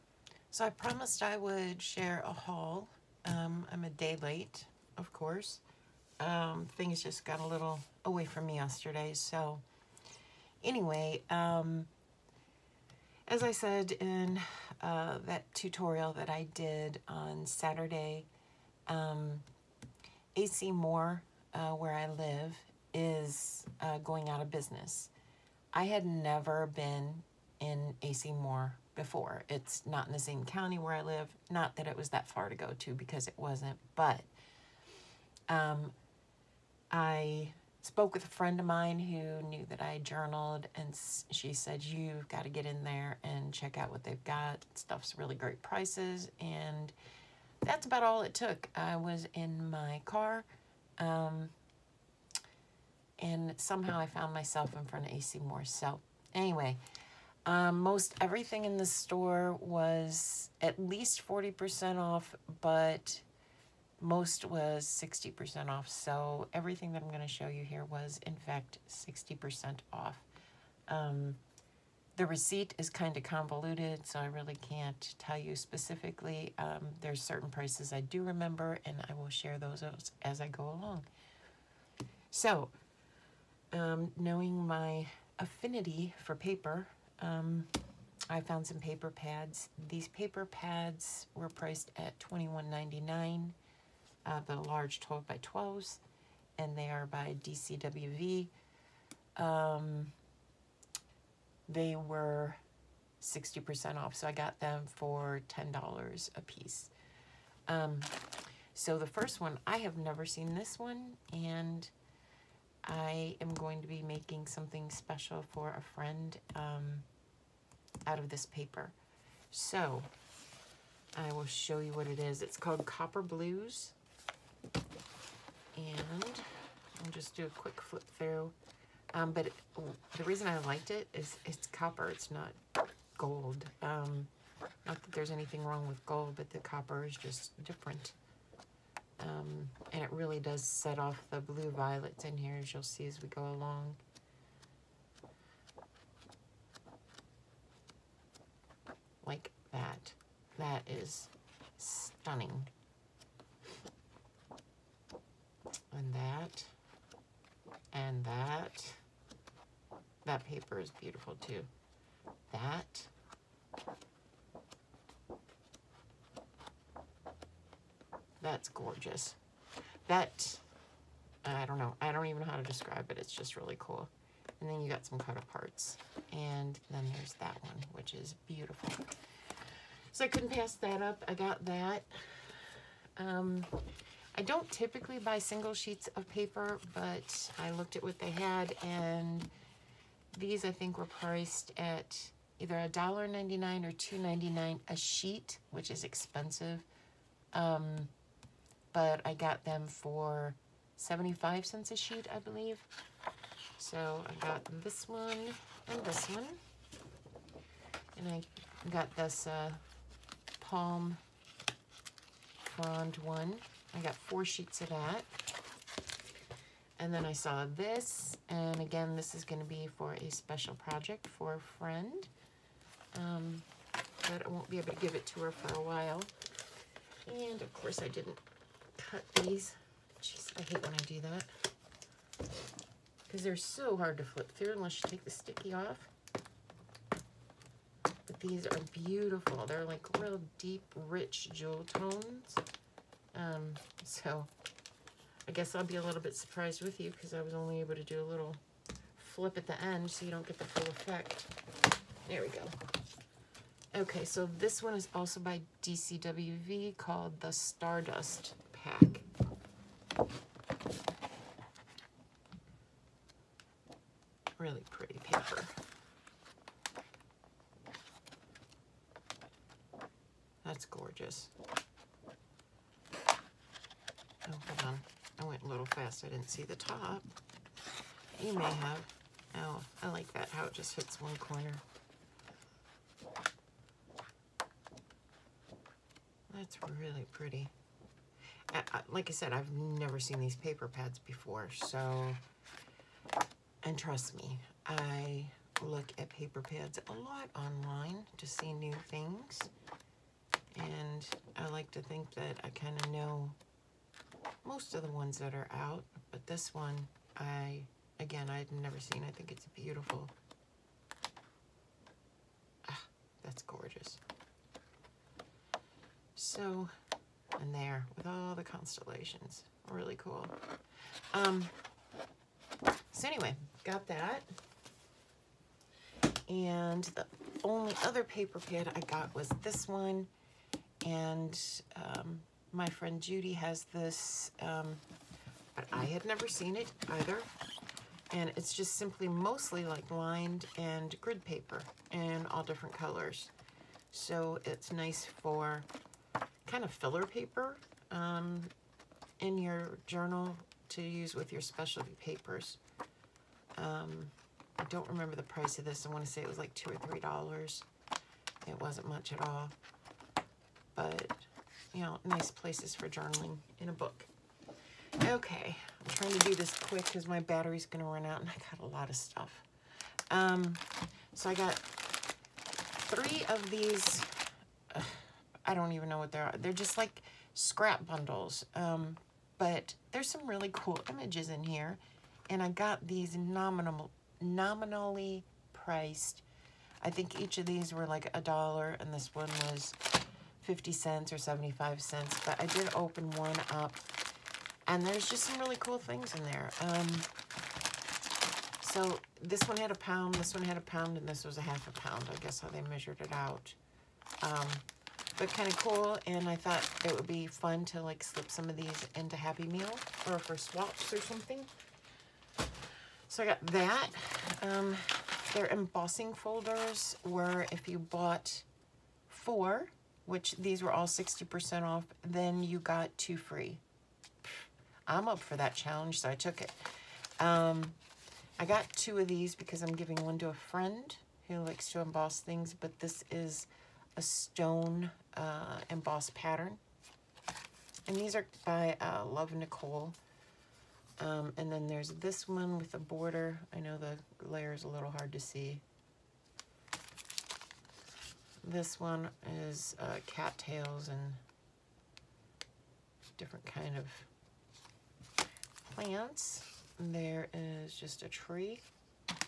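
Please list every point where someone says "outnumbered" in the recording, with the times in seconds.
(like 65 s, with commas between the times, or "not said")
not said.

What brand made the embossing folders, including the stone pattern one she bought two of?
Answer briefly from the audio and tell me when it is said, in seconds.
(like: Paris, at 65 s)
Love Nicole, at 439 s.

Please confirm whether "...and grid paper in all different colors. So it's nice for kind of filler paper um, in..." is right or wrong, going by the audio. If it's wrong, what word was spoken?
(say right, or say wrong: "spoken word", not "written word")
right.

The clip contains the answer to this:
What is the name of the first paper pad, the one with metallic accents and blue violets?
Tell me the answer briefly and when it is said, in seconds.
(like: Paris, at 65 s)
Copper Blues, at 122 s.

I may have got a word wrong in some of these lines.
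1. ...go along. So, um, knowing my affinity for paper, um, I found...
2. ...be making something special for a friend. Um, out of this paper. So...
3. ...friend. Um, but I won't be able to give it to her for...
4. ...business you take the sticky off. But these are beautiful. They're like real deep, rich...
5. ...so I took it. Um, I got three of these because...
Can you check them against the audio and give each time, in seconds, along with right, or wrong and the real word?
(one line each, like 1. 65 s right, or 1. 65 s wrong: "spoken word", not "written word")
1. 80 s right
2. 113 s right
3. 221 s right
4. 234 s wrong: "unless", not "business"
5. 426 s wrong: "two", not "three".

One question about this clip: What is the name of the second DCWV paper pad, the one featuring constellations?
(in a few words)
Stardust Pack.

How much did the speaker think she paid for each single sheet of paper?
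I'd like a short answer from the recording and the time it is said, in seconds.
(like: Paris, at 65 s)
75 cents, at 200 s.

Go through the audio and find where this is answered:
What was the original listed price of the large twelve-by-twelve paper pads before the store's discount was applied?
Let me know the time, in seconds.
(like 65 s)
92 s.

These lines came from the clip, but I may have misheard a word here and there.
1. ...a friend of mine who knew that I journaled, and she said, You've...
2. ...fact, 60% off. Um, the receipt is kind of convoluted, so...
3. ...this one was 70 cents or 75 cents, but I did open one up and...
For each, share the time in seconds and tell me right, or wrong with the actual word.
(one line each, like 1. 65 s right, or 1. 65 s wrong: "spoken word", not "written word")
1. 38 s right
2. 68 s right
3. 389 s wrong: "50", not "70".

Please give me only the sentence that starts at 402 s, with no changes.
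I guess how they measured it out.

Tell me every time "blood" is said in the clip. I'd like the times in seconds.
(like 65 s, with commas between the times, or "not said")
not said.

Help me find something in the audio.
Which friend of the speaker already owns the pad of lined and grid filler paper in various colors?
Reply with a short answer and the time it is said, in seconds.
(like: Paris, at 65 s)
Judy, at 333 s.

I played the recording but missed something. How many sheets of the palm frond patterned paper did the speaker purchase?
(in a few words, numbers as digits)
4.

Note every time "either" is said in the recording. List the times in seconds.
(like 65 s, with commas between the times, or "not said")
192 s, 337 s.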